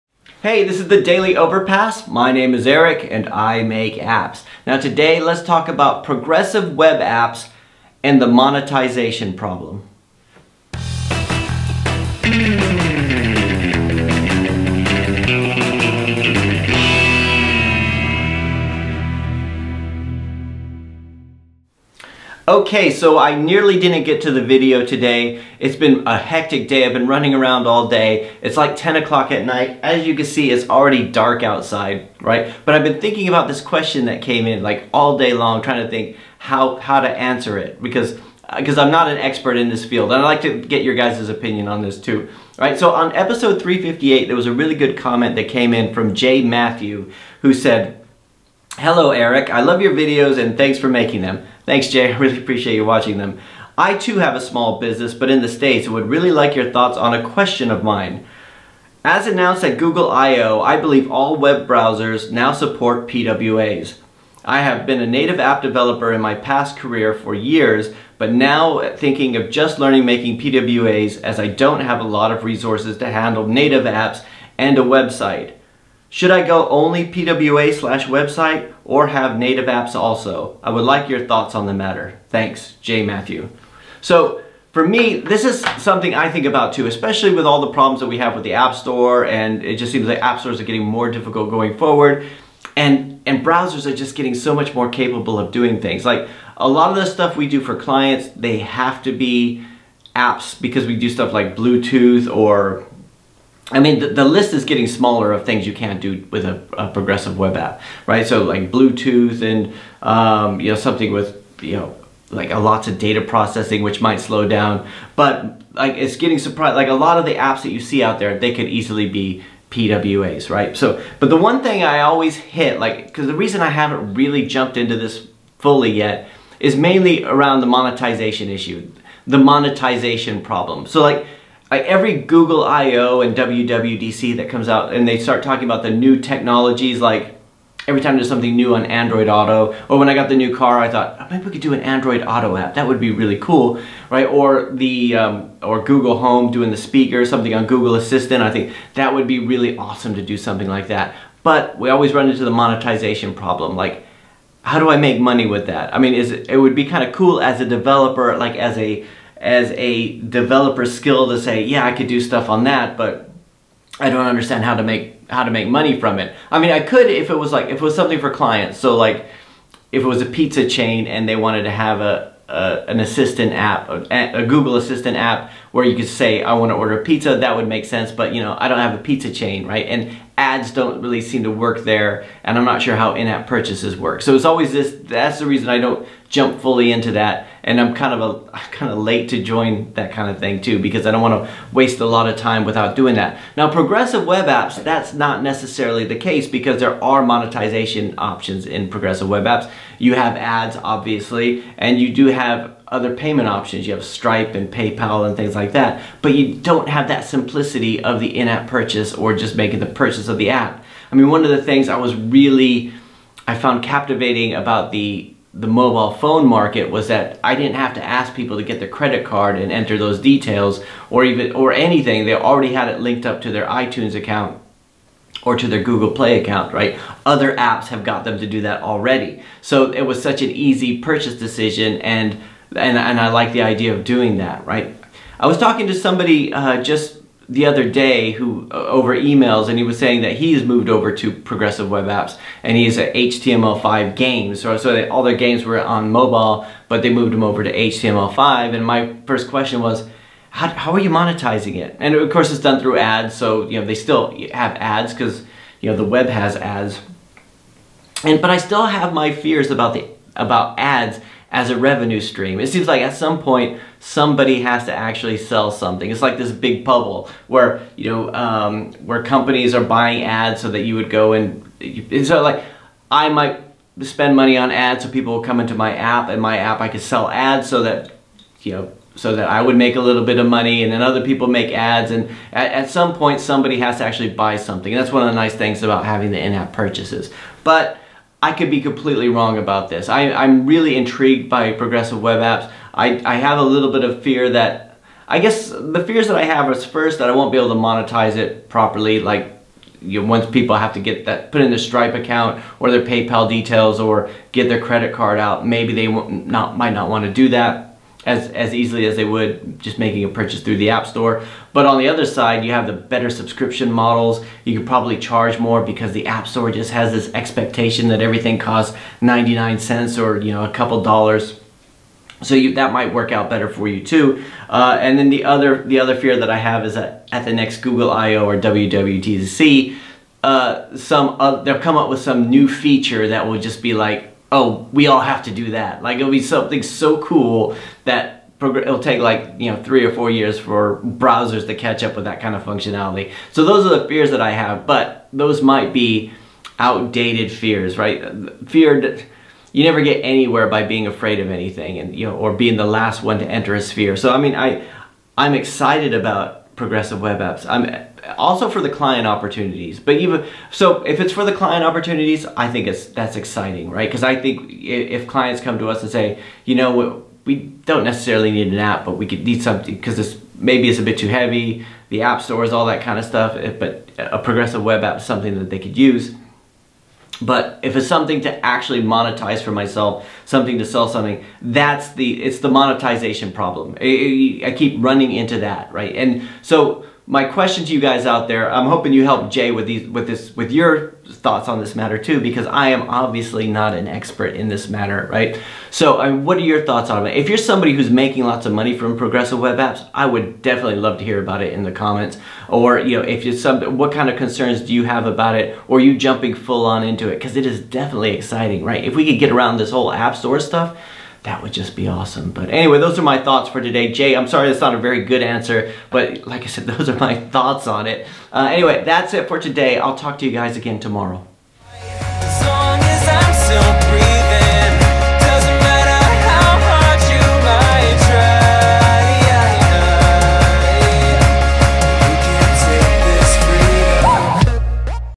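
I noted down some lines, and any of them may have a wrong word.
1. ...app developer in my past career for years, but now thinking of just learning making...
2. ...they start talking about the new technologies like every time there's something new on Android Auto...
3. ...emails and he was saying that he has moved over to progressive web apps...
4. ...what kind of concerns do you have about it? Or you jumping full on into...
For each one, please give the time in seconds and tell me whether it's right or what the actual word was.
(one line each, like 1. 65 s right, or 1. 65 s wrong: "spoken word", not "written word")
1. 65 s right
2. 135 s right
3. 239 s right
4. 403 s right.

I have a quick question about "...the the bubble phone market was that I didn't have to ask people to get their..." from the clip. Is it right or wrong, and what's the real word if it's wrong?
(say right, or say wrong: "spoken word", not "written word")
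wrong: "mobile", not "bubble".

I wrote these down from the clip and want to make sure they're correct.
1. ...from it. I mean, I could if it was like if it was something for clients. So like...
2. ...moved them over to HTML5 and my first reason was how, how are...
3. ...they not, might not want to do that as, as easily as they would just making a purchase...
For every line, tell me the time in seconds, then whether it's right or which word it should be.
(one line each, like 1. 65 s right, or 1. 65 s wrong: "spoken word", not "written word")
1. 165 s right
2. 247 s wrong: "question", not "reason"
3. 305 s right.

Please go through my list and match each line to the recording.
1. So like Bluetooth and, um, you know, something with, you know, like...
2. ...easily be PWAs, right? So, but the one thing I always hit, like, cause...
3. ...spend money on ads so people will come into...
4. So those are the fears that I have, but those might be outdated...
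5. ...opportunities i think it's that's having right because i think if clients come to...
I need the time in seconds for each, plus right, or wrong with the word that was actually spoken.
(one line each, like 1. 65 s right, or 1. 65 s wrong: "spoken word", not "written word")
1. 108 s right
2. 118 s right
3. 274 s right
4. 343 s right
5. 361 s wrong: "exciting", not "having".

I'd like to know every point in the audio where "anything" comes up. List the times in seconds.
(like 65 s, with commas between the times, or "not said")
221 s, 351 s.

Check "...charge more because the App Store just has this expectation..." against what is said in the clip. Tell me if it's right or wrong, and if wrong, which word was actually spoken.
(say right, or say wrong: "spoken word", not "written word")
right.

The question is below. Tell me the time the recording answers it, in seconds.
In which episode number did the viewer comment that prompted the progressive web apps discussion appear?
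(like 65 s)
43 s.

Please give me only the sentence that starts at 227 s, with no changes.
Other apps have got them to do that already.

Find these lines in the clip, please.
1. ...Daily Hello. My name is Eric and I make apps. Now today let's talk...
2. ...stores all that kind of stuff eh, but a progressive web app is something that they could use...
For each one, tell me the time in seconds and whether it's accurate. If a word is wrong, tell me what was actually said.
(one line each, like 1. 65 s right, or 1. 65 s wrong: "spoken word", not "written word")
1. 1 s wrong: "Overpass", not "Hello"
2. 372 s right.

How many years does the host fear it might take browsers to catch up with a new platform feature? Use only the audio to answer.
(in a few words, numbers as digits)
three or four years.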